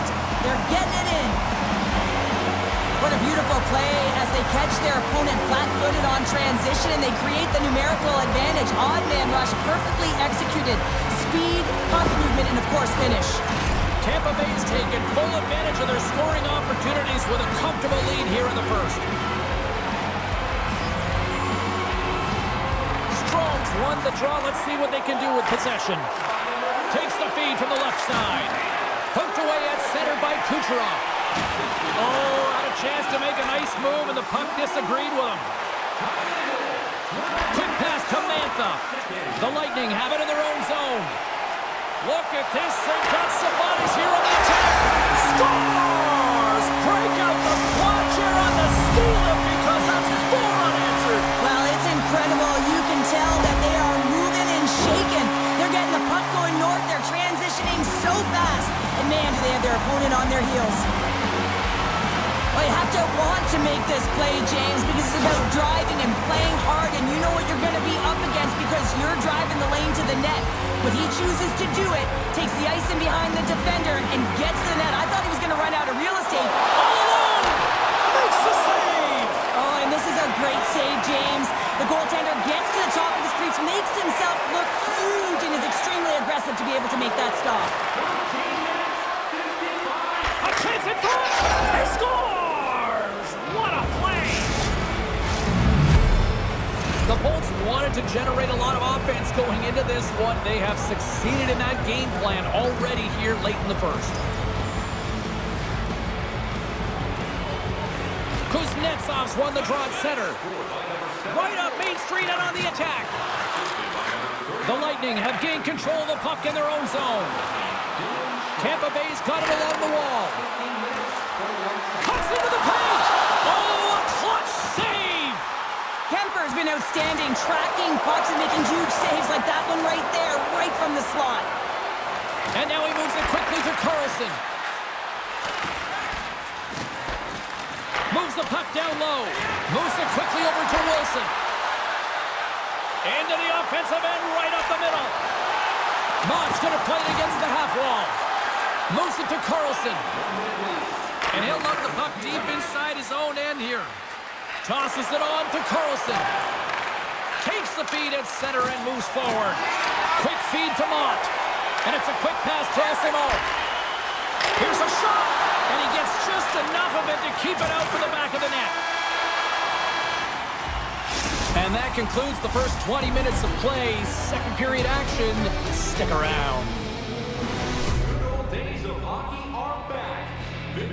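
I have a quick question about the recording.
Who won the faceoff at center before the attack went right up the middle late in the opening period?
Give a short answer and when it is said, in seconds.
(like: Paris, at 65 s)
Kuznetsov, at 108 s.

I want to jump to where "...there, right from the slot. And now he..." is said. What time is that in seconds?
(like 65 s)
130 s.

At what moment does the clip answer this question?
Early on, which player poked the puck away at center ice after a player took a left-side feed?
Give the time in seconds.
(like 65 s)
30 s.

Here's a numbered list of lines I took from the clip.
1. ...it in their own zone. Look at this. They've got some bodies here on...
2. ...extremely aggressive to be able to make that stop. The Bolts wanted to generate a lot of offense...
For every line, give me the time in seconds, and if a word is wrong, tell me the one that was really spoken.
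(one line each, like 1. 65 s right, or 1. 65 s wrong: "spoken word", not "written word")
1. 40 s right
2. 85 s right.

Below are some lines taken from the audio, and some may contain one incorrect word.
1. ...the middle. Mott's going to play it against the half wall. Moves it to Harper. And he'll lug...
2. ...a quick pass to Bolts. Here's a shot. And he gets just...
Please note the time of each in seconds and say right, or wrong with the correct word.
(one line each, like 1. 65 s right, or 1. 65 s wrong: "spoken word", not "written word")
1. 144 s wrong: "Carlson", not "Harper"
2. 162 s wrong: "Osimo", not "Bolts".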